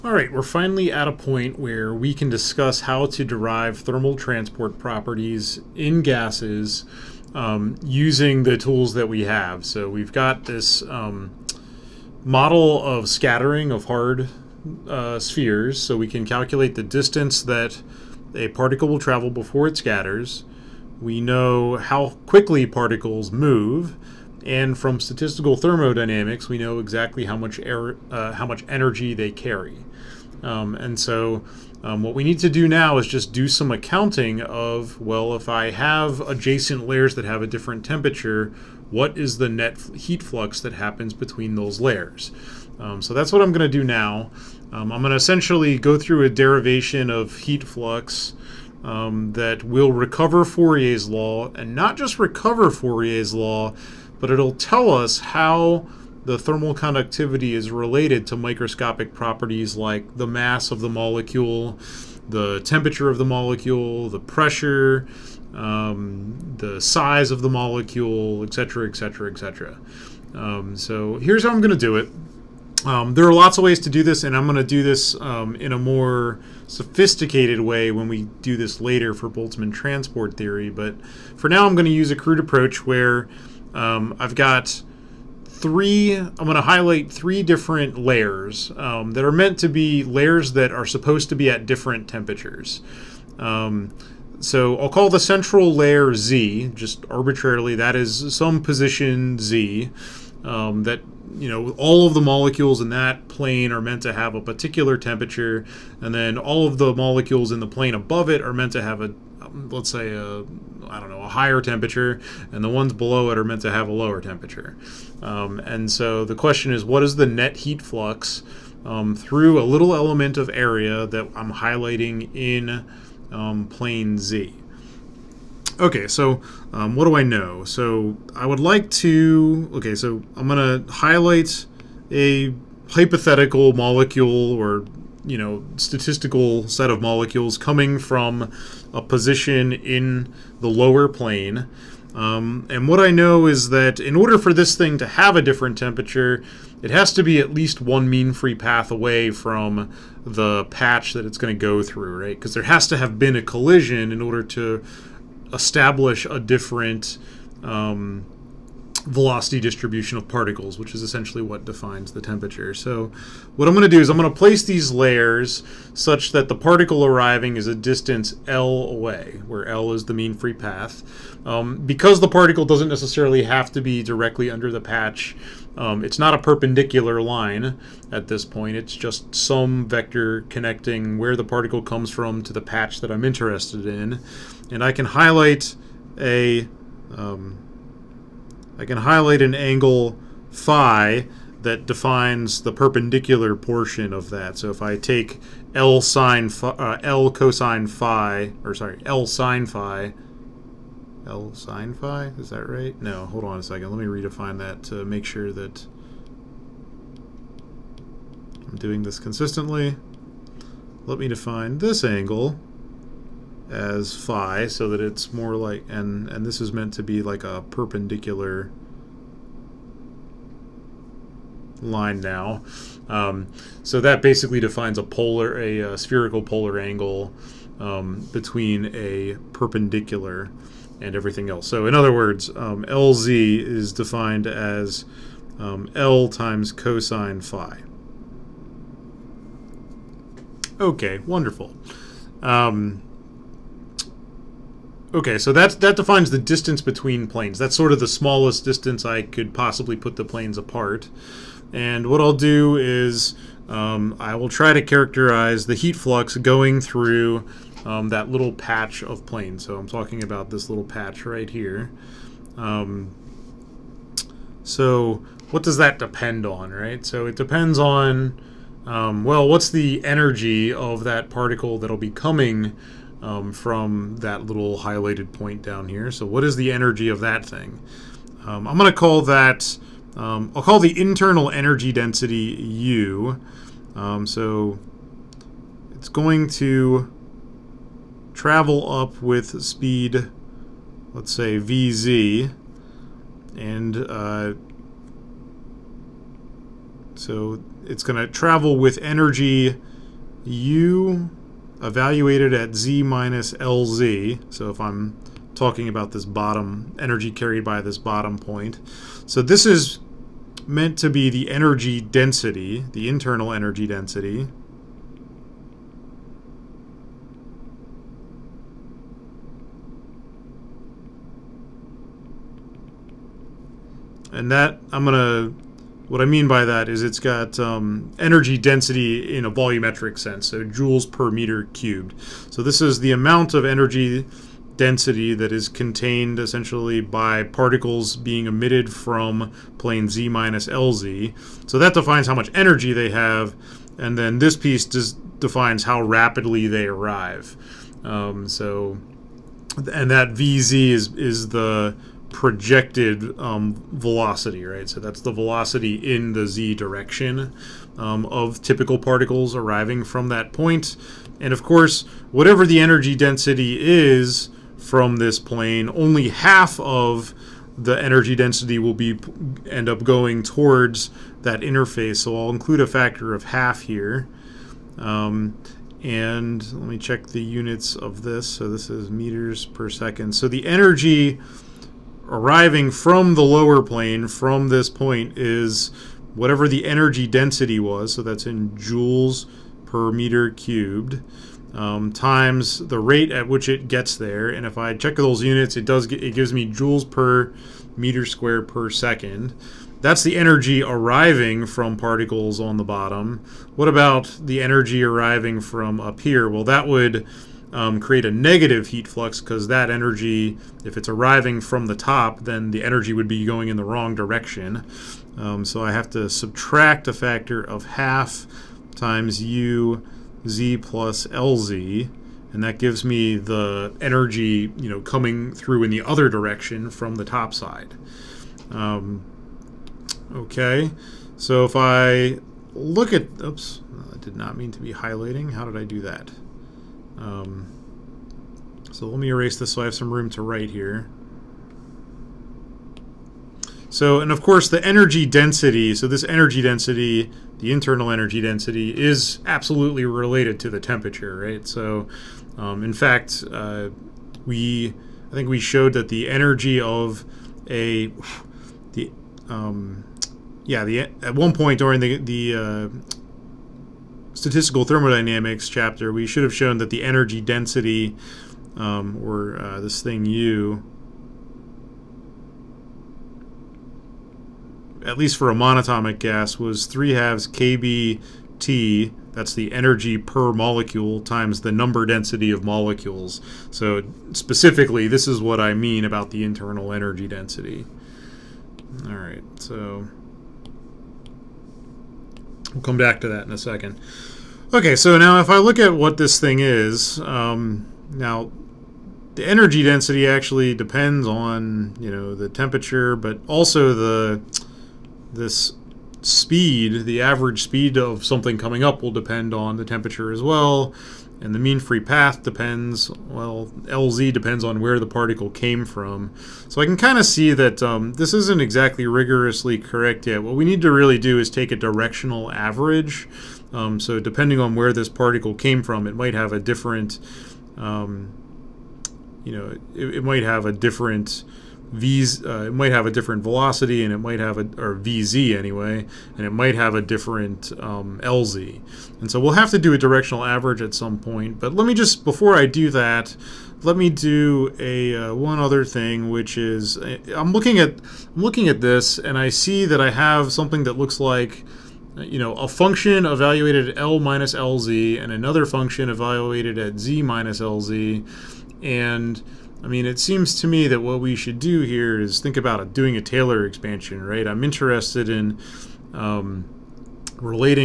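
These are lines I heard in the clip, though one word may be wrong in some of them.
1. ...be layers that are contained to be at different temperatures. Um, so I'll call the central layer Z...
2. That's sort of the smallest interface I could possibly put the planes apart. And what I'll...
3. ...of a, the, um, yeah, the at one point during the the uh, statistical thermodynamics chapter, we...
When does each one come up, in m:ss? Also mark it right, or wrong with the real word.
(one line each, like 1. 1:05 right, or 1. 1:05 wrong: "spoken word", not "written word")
1. 1:29 wrong: "supposed", not "contained"
2. 4:07 wrong: "distance", not "interface"
3. 7:36 right.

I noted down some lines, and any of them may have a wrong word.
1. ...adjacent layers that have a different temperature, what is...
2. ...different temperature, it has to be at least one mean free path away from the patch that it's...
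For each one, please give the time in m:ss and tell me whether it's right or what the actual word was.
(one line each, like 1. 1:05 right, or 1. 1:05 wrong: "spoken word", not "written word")
1. 0:36 right
2. 2:25 right.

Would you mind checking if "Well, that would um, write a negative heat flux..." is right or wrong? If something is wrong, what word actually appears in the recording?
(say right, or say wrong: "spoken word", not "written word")
wrong: "create", not "write".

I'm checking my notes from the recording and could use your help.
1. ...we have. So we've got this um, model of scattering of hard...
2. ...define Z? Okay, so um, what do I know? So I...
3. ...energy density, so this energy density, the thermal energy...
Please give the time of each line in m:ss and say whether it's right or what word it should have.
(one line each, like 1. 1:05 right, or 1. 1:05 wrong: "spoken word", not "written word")
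1. 0:09 right
2. 2:03 wrong: "plane", not "define"
3. 7:24 wrong: "internal", not "thermal".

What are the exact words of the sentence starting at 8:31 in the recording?
And the mean free path depends, well, LZ depends on where the particle came from.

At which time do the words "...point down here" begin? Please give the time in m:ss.
4:35.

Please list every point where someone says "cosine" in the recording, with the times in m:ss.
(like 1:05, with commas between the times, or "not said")
3:17, 3:56.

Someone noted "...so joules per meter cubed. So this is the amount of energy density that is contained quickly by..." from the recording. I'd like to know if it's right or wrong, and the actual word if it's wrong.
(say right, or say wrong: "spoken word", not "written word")
wrong: "essentially", not "quickly".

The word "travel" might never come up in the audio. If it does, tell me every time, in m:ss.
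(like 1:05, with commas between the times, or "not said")
0:18, 4:48, 4:58.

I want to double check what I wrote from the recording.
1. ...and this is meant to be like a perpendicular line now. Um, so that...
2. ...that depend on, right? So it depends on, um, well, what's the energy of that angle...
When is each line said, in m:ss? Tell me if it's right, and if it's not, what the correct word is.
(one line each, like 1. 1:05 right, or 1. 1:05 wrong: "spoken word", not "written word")
1. 3:36 right
2. 4:25 wrong: "particle", not "angle".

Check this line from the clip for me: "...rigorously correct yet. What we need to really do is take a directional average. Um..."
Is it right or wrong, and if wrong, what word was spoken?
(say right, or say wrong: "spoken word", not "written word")
right.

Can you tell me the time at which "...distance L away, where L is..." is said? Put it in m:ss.
2:47.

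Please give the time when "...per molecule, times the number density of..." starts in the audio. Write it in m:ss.
8:00.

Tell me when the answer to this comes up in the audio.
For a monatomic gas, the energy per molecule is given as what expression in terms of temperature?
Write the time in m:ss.
7:56.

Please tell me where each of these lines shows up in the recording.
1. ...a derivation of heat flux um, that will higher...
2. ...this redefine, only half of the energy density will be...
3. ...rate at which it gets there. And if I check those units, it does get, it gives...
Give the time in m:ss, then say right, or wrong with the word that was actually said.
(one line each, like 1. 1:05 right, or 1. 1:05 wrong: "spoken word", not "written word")
1. 0:46 wrong: "recover", not "higher"
2. 6:05 wrong: "plane", not "redefine"
3. 6:32 right.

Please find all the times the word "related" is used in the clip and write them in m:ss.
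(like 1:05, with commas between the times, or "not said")
0:57, 7:30.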